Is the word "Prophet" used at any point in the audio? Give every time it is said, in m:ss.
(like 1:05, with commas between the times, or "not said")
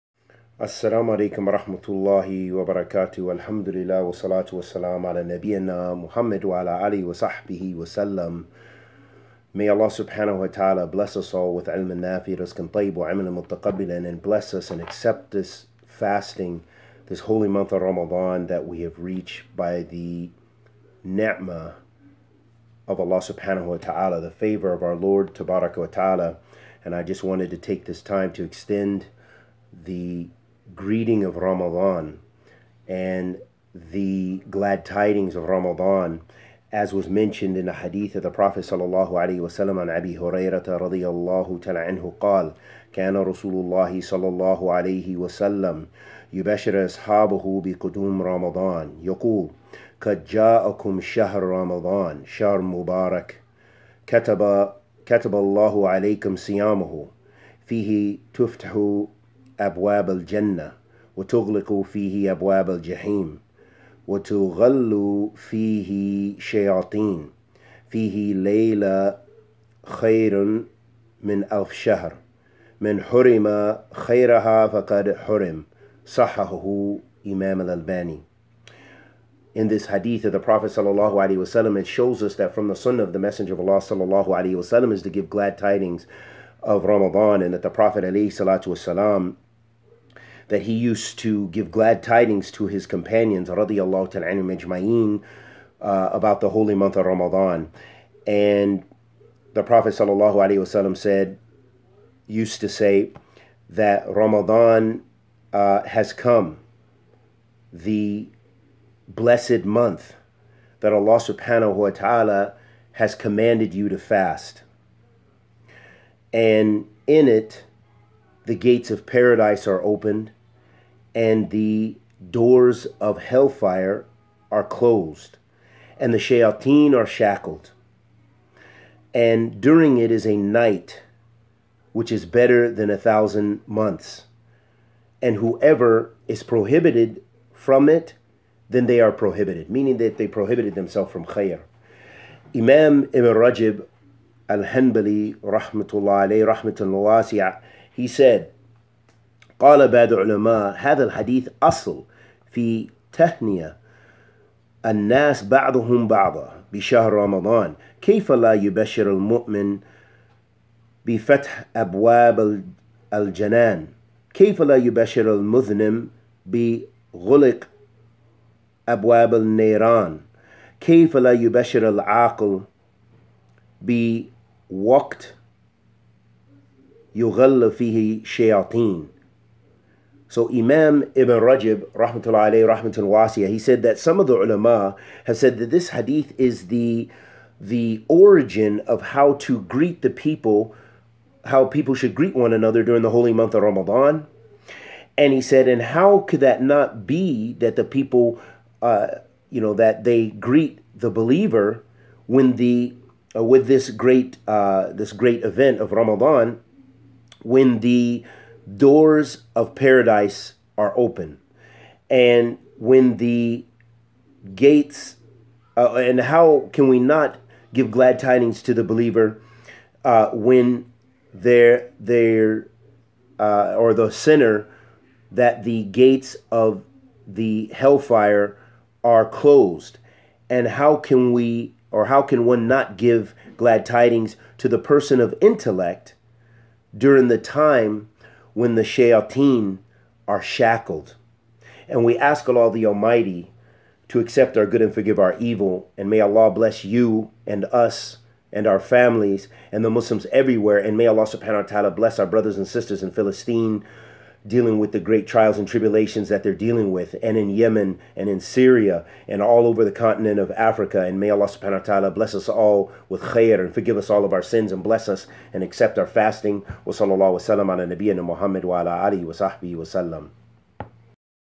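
0:38, 1:20, 1:27, 1:39.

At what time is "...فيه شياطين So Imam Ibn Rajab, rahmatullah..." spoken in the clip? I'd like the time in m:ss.
2:57.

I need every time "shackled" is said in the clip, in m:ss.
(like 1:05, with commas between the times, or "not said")
2:07, 4:00.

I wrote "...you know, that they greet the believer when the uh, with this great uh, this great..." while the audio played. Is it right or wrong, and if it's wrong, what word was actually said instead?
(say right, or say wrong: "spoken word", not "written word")
right.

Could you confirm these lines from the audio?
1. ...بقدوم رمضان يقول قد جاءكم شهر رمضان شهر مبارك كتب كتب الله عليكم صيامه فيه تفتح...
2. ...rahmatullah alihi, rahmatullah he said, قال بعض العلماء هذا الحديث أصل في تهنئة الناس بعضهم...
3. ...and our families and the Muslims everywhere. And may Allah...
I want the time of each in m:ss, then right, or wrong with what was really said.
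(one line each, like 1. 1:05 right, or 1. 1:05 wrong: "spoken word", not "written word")
1. 0:47 right
2. 2:25 wrong: "alayhi", not "alihi"
3. 4:08 right.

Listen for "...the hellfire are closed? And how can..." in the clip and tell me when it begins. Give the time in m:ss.
3:47.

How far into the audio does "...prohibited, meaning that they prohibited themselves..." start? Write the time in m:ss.
2:19.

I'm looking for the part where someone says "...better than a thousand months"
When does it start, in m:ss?
2:12.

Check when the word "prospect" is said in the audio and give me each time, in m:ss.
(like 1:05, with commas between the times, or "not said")
not said.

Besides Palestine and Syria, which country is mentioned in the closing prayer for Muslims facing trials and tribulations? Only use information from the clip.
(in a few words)
Yemen.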